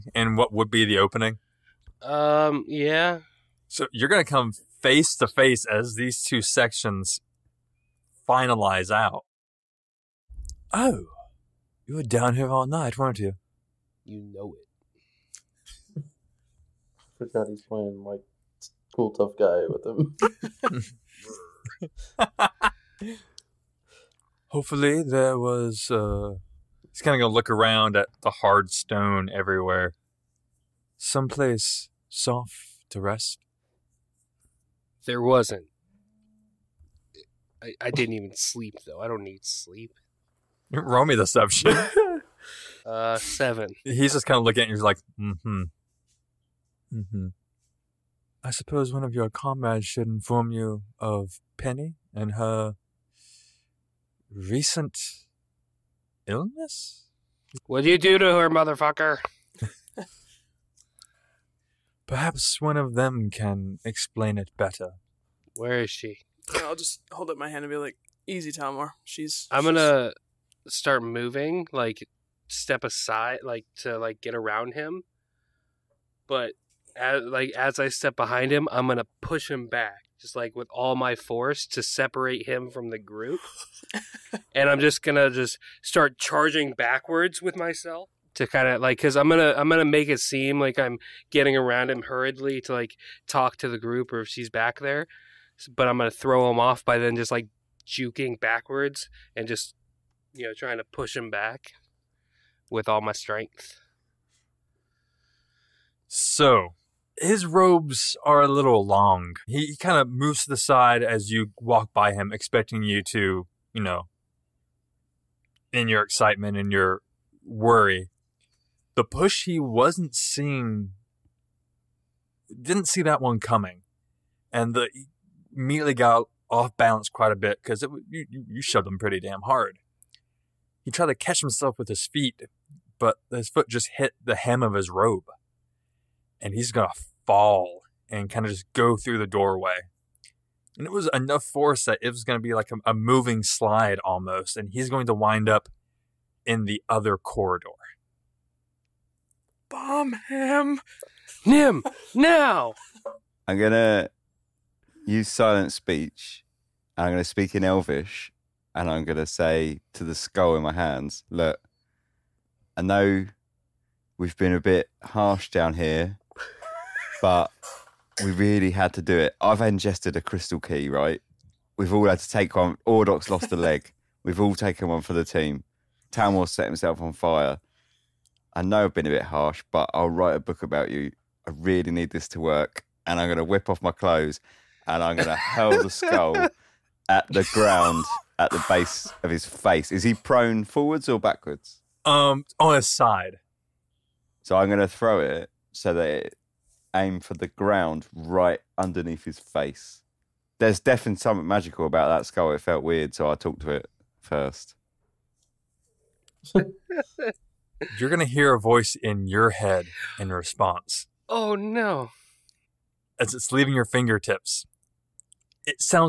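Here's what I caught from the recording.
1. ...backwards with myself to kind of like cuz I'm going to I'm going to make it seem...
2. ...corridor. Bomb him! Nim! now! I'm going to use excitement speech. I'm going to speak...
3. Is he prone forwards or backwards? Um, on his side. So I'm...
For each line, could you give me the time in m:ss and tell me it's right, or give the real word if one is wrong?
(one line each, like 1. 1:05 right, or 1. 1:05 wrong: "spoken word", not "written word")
1. 1:26 right
2. 2:27 wrong: "silent", not "excitement"
3. 3:09 right.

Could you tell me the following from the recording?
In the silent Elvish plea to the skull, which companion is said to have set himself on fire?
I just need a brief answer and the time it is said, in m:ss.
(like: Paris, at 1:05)
Tamworth, at 2:56.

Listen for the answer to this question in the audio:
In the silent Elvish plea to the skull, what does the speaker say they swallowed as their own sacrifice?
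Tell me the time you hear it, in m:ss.
2:50.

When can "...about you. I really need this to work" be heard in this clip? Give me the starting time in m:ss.
3:00.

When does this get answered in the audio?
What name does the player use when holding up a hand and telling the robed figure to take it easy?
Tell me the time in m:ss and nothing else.
1:08.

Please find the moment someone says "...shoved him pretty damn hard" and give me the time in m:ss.
2:08.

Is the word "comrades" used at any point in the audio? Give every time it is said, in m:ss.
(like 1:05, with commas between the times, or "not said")
0:49.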